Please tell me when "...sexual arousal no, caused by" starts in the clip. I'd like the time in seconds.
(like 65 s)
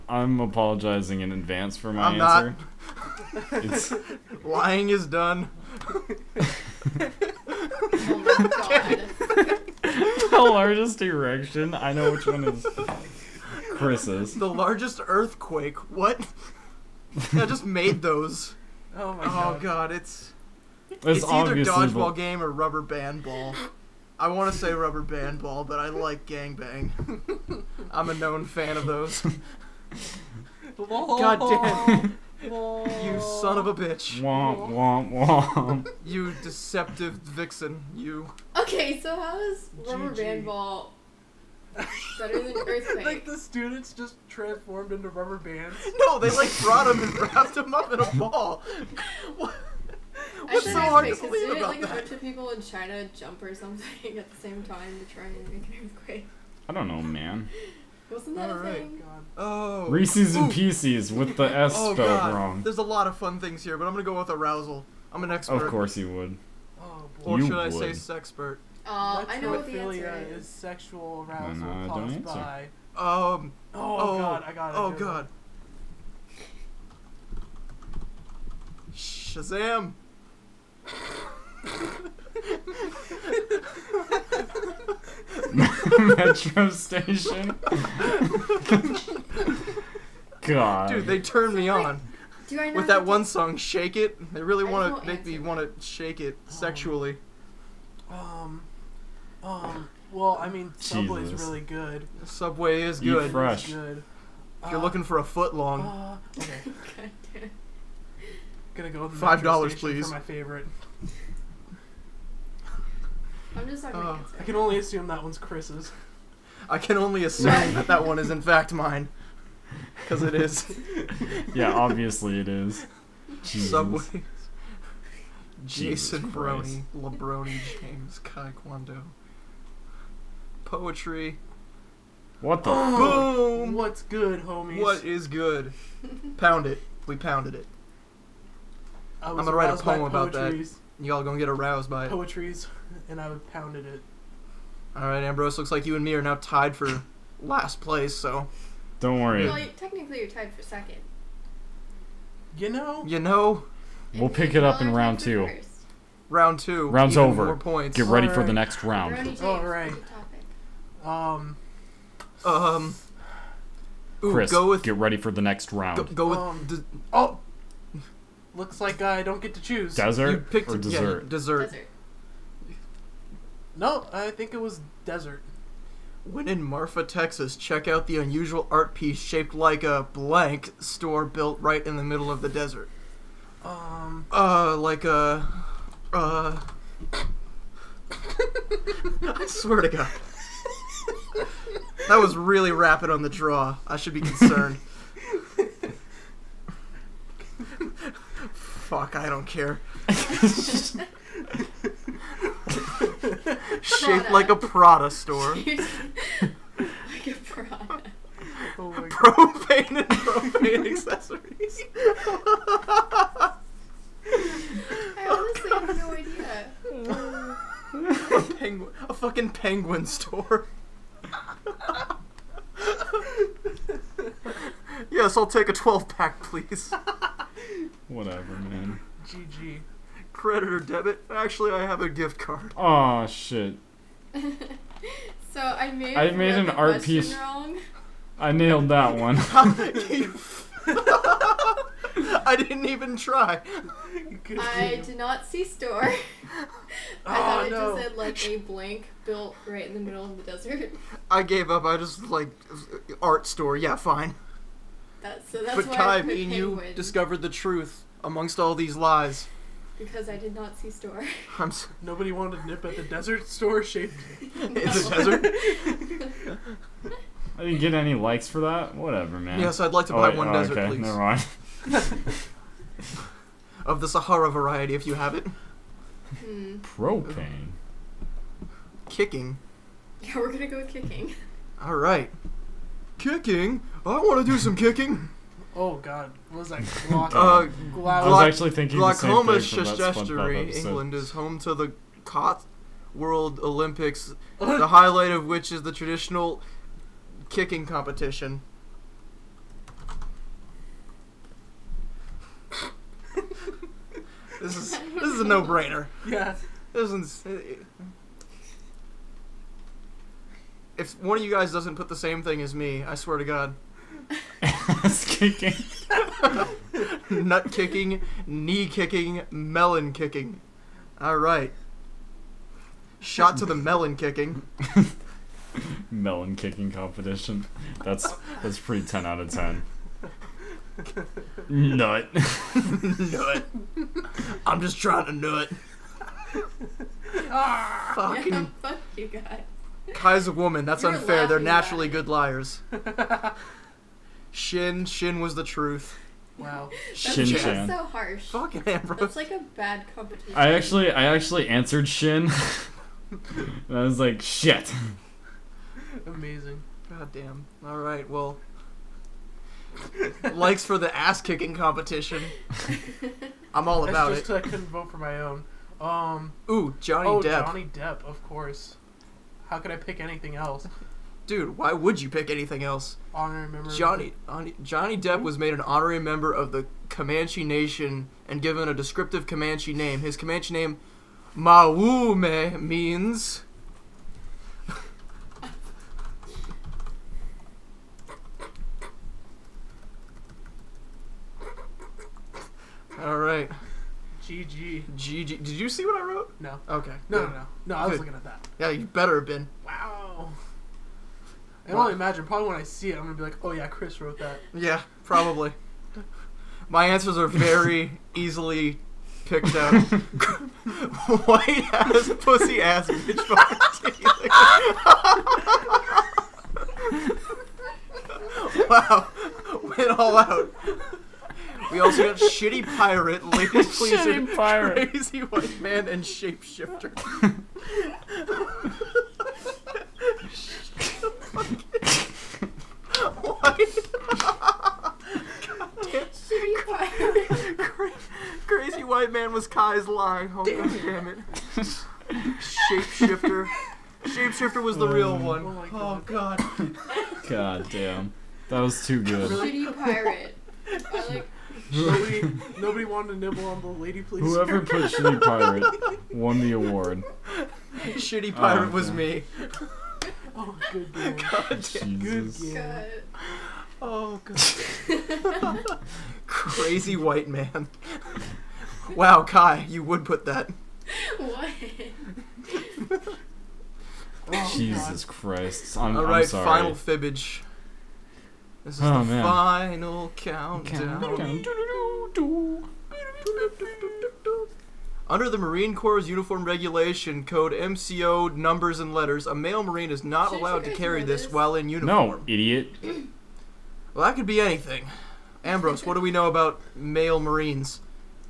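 70 s.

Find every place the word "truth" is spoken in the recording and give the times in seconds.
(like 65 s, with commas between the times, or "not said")
257 s, 345 s.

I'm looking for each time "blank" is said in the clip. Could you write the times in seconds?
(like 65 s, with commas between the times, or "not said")
180 s, 248 s.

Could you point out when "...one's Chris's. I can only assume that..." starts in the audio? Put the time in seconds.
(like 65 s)
115 s.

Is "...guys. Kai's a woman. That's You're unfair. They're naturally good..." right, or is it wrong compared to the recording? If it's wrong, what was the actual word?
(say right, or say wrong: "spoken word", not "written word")
right.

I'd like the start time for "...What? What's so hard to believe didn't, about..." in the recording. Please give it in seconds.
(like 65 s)
49 s.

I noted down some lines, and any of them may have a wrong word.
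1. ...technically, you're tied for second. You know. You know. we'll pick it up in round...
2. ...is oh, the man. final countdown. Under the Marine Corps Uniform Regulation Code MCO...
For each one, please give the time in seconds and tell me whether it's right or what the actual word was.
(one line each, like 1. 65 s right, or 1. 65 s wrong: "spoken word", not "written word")
1. 149 s right
2. 478 s right.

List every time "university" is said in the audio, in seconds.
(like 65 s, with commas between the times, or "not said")
not said.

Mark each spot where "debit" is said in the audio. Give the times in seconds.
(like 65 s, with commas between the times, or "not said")
230 s.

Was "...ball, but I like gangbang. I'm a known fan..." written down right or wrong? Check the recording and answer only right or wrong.
right.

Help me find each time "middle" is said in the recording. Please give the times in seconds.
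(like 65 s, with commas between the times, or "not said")
182 s, 249 s.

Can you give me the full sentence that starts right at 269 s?
Yes, yeah, so I'd like to buy oh, wait, one oh, desert, okay.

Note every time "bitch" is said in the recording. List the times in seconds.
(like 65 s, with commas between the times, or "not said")
33 s, 413 s.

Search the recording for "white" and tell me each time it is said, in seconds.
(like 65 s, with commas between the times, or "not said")
411 s, 425 s, 439 s, 467 s.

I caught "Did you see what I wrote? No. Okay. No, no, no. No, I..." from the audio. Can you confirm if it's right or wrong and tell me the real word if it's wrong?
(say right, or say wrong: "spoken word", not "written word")
right.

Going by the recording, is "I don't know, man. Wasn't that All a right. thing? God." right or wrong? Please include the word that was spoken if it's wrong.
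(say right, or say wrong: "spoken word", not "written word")
right.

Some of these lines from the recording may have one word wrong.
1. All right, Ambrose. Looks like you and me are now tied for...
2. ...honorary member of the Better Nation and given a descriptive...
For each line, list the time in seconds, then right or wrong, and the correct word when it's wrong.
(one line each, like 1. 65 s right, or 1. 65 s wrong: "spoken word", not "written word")
1. 144 s right
2. 375 s wrong: "Comanche", not "Better".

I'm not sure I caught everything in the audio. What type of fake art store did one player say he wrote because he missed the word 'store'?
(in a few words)
penguin store.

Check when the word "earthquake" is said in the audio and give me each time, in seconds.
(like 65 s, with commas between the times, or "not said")
15 s, 42 s, 55 s.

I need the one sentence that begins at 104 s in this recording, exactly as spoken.
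If you're uh, looking for a foot long, Uh, okay.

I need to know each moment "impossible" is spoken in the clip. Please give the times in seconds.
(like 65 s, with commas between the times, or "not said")
not said.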